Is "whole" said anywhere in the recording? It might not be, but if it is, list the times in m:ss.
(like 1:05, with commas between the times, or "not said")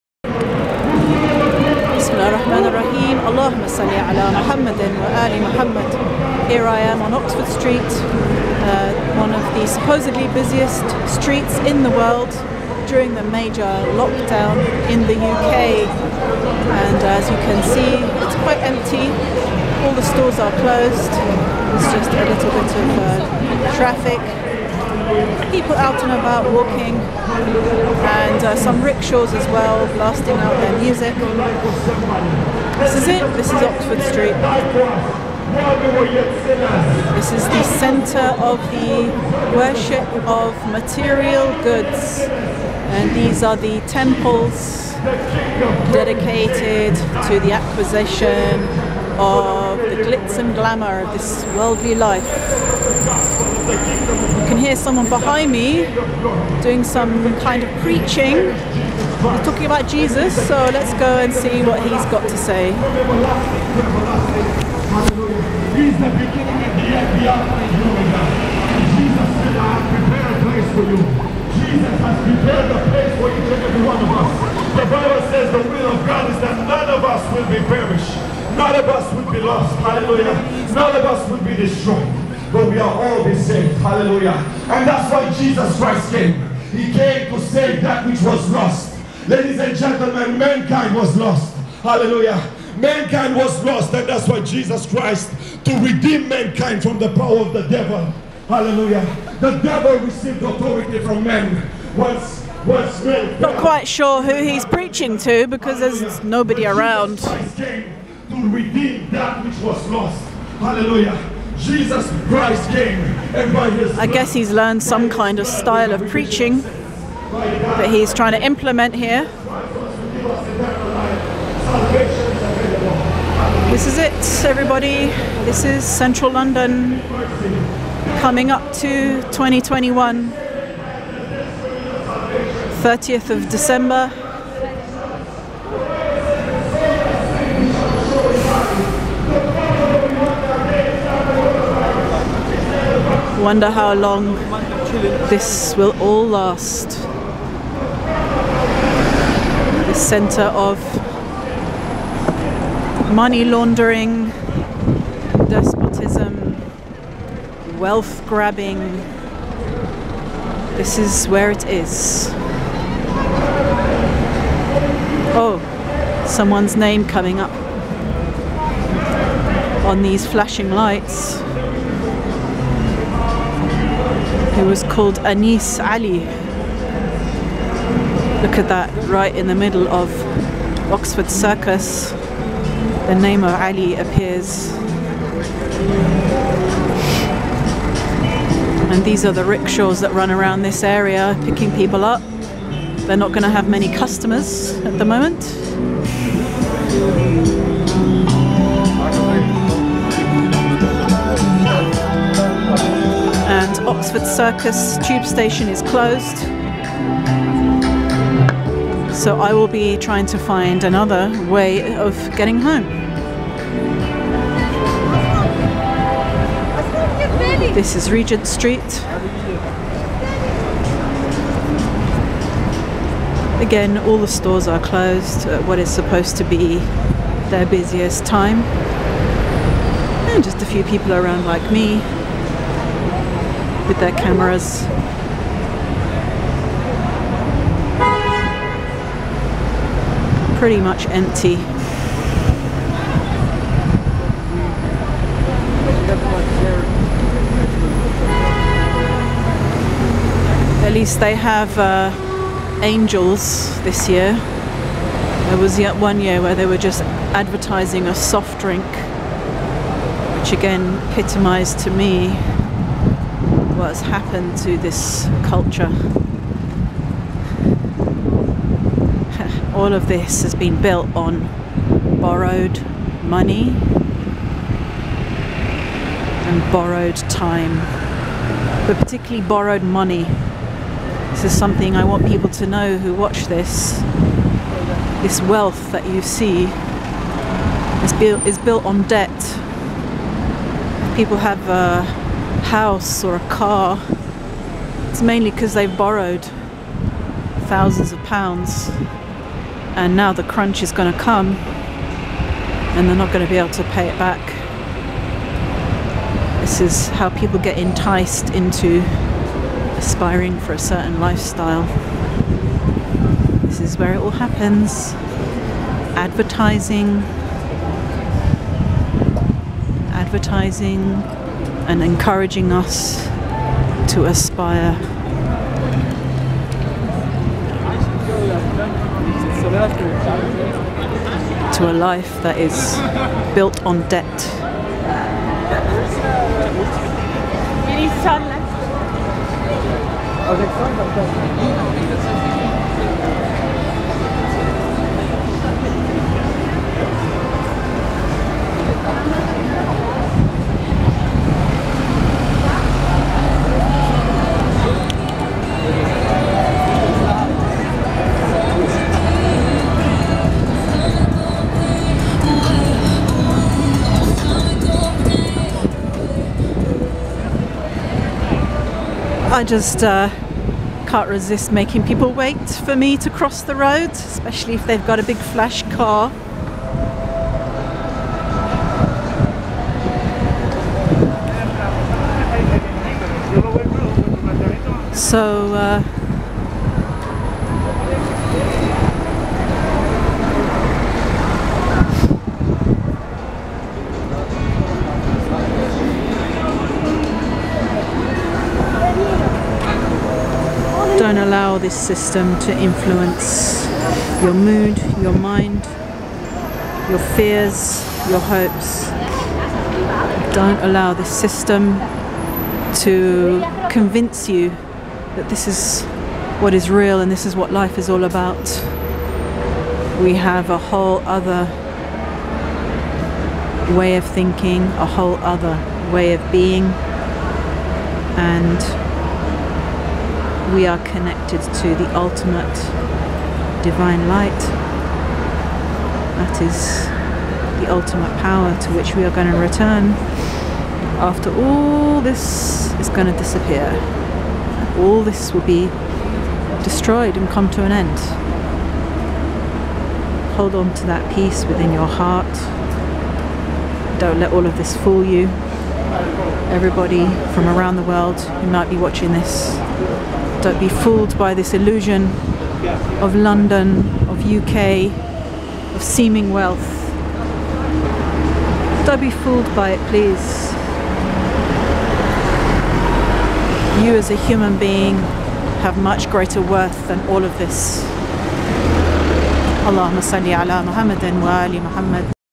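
7:00, 7:05.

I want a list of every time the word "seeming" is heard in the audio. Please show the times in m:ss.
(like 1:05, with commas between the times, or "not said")
7:46.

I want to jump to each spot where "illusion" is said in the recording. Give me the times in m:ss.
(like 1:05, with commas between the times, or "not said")
7:41.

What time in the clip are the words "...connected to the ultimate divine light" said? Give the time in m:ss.
7:11.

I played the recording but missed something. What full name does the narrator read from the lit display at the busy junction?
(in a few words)
Anis Ali.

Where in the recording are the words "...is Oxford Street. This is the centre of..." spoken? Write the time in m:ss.
0:33.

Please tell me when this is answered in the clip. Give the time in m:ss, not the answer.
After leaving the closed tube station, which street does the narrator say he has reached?
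3:38.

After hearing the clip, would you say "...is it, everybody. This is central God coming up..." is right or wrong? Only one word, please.
wrong.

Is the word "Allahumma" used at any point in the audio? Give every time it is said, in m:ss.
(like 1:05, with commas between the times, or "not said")
0:03, 7:59.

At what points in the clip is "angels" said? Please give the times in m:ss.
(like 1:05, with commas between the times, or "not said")
4:12.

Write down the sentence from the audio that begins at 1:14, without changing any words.
The Bible says the will of God is that none of us will be perished.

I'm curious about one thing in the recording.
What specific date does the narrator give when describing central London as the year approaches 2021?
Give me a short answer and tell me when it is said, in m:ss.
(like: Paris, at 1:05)
30th of December, at 2:12.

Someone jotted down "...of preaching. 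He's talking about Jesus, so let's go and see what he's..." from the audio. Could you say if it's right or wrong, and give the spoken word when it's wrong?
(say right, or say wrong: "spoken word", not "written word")
right.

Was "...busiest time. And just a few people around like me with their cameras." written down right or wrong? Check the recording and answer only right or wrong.
right.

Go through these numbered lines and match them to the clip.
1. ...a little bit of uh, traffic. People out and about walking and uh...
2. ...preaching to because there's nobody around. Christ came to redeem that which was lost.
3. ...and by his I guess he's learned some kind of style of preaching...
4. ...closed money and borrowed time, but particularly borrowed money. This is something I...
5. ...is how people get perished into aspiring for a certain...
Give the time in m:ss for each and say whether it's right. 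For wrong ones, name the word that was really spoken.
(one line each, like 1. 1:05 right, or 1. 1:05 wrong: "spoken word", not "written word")
1. 0:22 right
2. 1:44 right
3. 1:53 right
4. 4:32 wrong: "borrowed", not "closed"
5. 5:06 wrong: "enticed", not "perished".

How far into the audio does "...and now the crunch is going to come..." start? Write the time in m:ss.
4:59.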